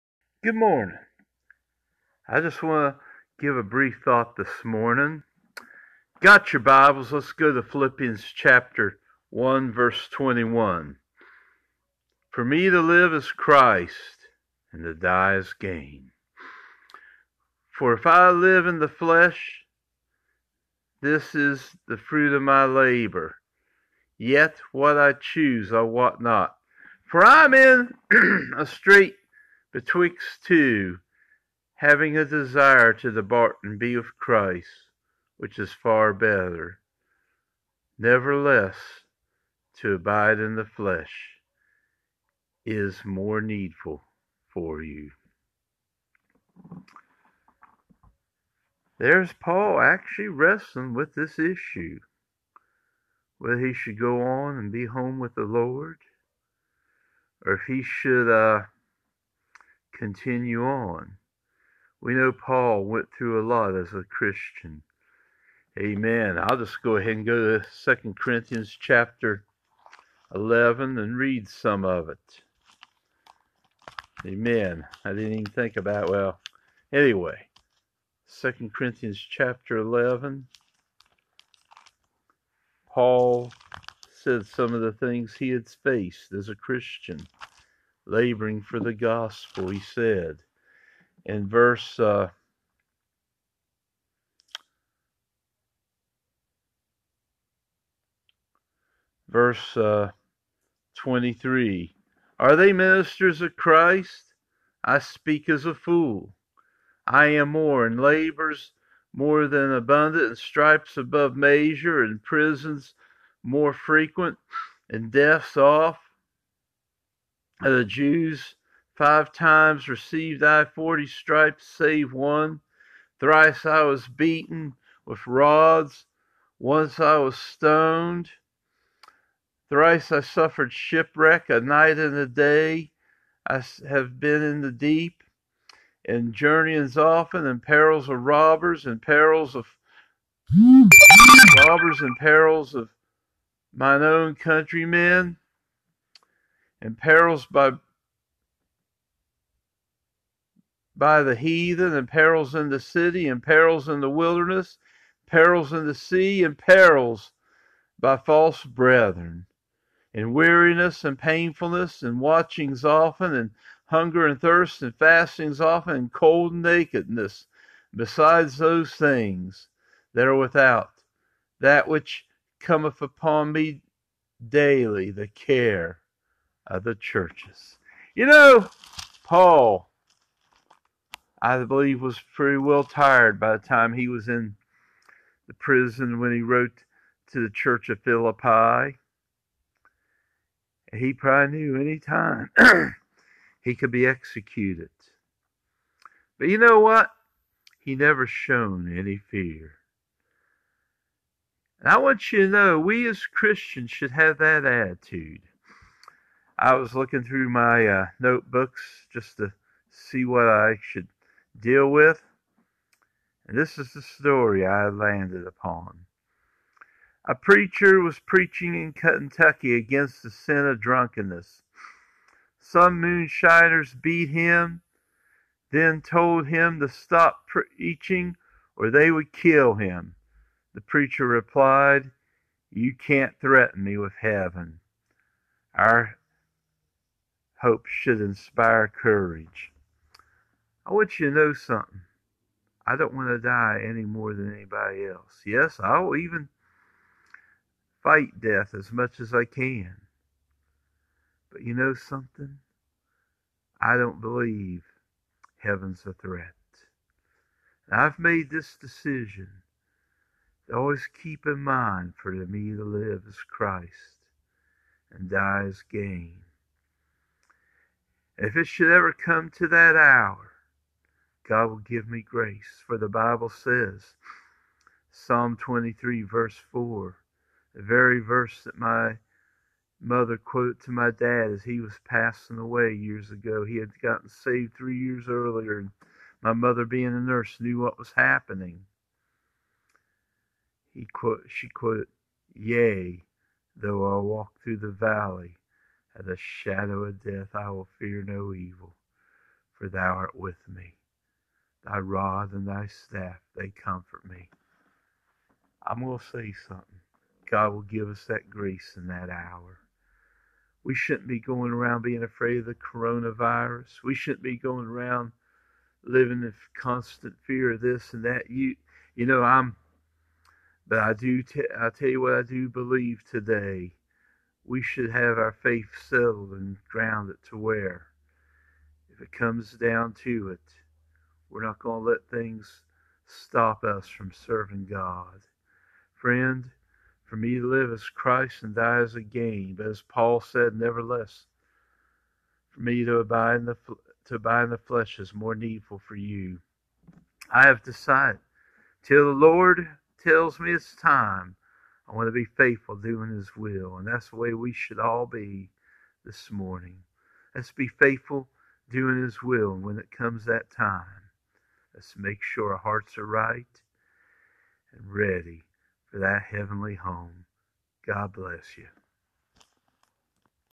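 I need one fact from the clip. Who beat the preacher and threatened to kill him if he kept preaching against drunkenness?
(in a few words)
Moonshiners.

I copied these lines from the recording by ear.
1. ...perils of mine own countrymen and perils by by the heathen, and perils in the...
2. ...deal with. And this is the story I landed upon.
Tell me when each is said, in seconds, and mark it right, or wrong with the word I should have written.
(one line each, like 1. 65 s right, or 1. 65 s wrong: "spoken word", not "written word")
1. 142 s right
2. 211 s right.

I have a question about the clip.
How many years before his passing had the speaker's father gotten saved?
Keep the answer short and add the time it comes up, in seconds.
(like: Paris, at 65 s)
3, at 284 s.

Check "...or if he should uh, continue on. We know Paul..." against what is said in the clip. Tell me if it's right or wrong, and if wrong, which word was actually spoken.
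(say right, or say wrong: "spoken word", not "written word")
right.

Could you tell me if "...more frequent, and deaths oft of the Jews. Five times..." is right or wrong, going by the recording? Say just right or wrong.
right.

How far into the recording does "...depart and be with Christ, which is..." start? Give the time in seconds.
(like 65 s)
33 s.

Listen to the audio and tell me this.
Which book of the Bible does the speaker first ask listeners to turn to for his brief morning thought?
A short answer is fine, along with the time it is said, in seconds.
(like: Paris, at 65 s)
Philippians, at 7 s.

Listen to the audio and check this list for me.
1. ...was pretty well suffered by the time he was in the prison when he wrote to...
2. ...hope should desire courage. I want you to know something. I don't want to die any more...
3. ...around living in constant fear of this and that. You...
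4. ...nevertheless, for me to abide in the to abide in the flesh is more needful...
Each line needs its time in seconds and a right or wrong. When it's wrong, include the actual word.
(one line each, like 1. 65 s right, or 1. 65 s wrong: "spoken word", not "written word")
1. 182 s wrong: "tired", not "suffered"
2. 237 s wrong: "inspire", not "desire"
3. 314 s right
4. 340 s right.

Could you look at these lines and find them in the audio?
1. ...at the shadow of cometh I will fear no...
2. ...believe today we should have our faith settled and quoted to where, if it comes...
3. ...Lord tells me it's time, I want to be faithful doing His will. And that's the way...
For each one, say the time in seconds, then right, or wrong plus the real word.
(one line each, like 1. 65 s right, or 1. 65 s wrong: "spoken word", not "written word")
1. 296 s wrong: "death", not "cometh"
2. 322 s wrong: "grounded", not "quoted"
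3. 349 s right.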